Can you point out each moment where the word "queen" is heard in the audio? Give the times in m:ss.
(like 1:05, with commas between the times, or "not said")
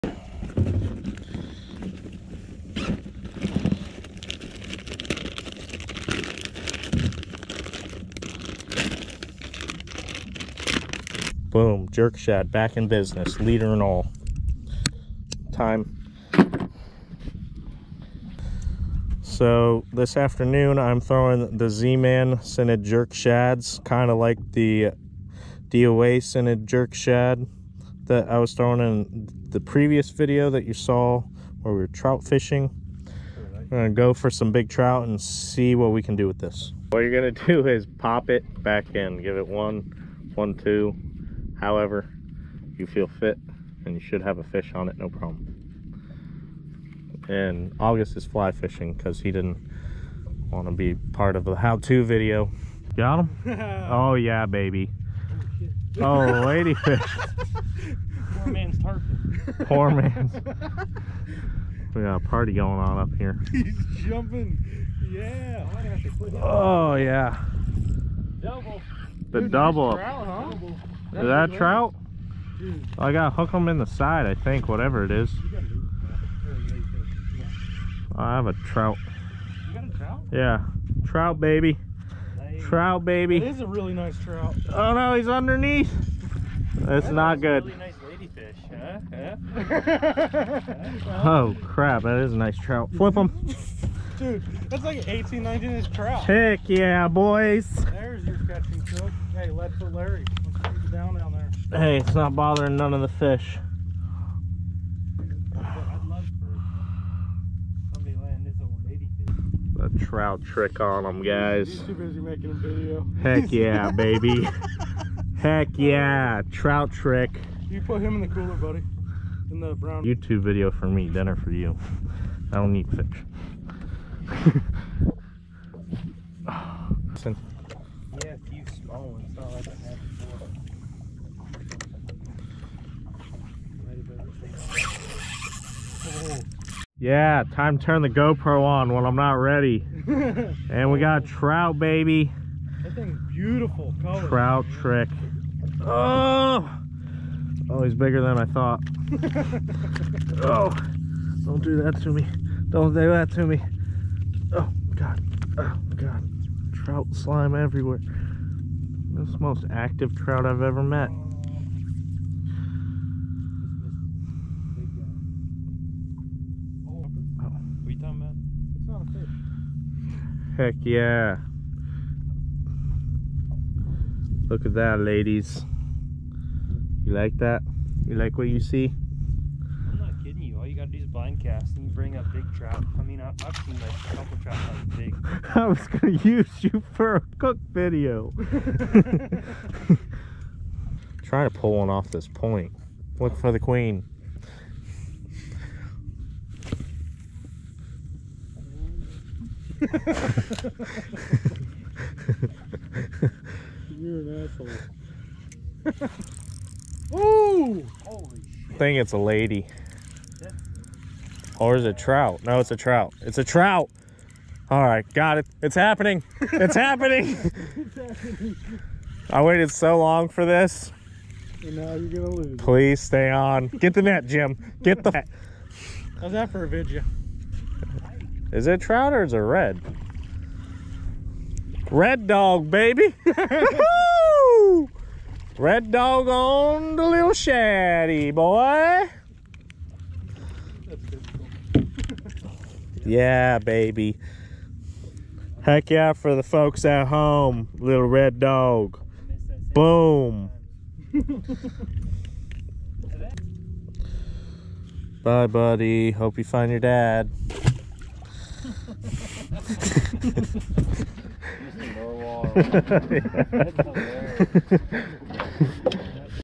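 3:13.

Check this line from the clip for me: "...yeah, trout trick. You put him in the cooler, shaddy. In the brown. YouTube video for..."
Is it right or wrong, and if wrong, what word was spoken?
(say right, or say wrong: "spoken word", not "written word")
wrong: "buddy", not "shaddy".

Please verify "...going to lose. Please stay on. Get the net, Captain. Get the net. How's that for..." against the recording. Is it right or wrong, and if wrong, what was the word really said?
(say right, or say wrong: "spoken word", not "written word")
wrong: "Jim", not "Captain".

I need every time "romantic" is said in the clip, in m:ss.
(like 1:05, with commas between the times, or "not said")
not said.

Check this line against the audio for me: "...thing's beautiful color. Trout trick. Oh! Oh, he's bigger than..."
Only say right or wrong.
right.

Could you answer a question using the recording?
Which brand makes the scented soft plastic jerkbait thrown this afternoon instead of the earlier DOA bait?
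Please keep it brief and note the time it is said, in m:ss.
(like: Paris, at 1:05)
Z-Man, at 0:21.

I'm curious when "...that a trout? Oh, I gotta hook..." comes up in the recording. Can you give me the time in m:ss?
1:11.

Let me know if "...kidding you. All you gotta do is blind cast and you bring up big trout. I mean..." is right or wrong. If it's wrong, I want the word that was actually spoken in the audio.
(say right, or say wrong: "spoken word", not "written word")
right.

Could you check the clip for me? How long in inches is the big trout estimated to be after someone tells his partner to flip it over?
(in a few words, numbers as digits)
18 to 19 inches.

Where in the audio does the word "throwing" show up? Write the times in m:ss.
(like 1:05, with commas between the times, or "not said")
0:21, 0:28.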